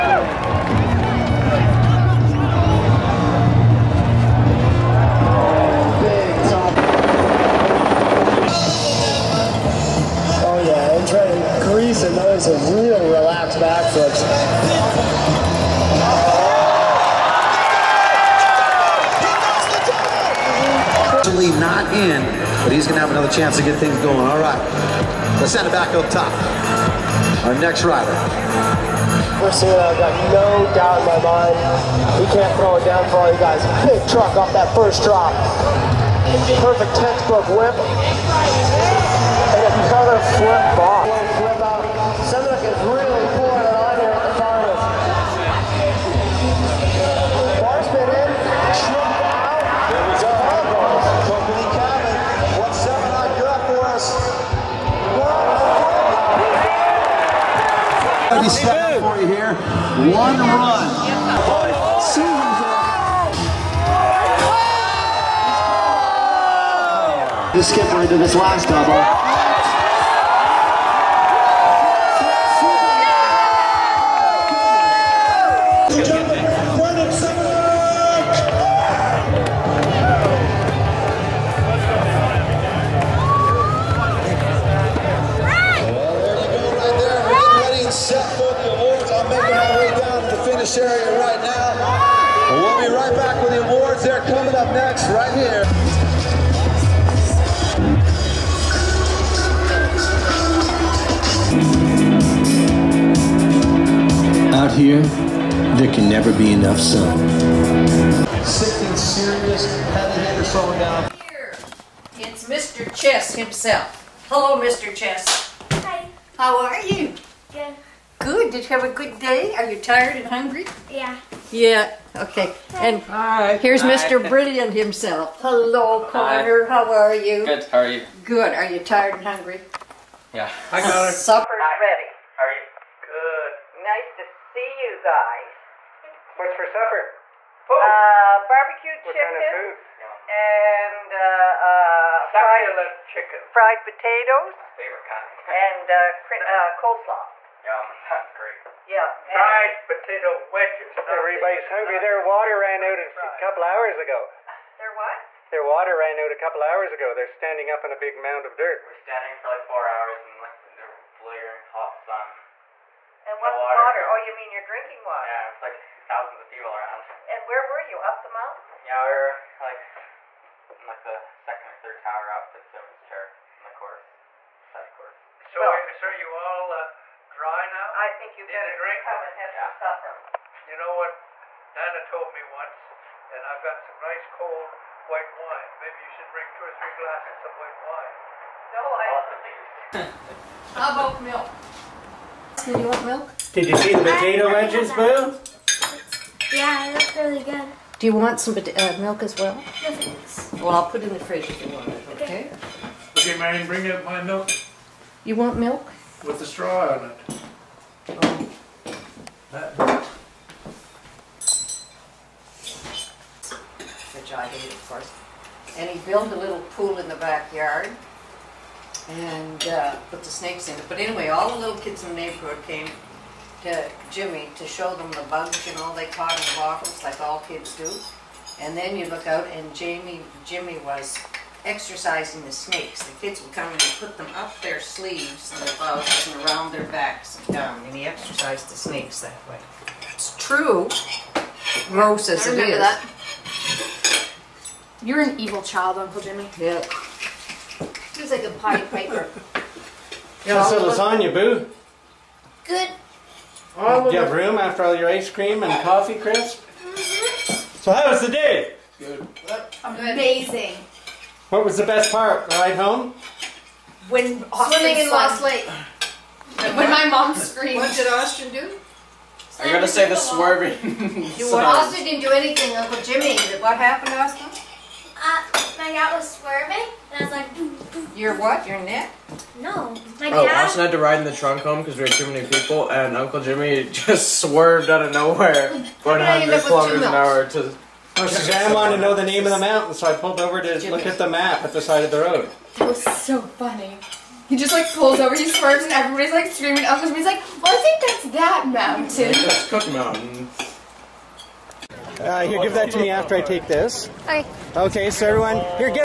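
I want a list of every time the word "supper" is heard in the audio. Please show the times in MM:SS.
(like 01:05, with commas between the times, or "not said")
02:11, 02:16, 02:59.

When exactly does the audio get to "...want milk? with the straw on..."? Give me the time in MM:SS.
03:25.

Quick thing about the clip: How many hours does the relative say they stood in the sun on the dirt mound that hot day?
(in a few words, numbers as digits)
4.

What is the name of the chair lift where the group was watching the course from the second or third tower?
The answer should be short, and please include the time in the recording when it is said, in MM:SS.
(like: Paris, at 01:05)
Simmons Chair, at 02:52.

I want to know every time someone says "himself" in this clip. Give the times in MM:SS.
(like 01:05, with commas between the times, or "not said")
01:53, 02:04.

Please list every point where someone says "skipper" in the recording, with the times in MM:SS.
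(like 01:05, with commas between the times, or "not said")
01:07.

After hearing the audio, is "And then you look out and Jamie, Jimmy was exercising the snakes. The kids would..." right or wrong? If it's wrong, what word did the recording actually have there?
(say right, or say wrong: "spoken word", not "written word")
right.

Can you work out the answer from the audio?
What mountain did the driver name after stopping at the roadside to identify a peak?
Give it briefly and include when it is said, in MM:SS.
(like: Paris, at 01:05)
Cook Mountain, at 04:59.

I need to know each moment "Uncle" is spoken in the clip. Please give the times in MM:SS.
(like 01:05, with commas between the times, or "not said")
04:05, 04:32, 04:43.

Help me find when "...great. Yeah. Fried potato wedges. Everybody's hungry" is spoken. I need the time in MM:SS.
02:28.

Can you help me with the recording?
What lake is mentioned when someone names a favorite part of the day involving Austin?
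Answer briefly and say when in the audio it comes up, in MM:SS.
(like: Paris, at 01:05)
Lost Lake, at 04:25.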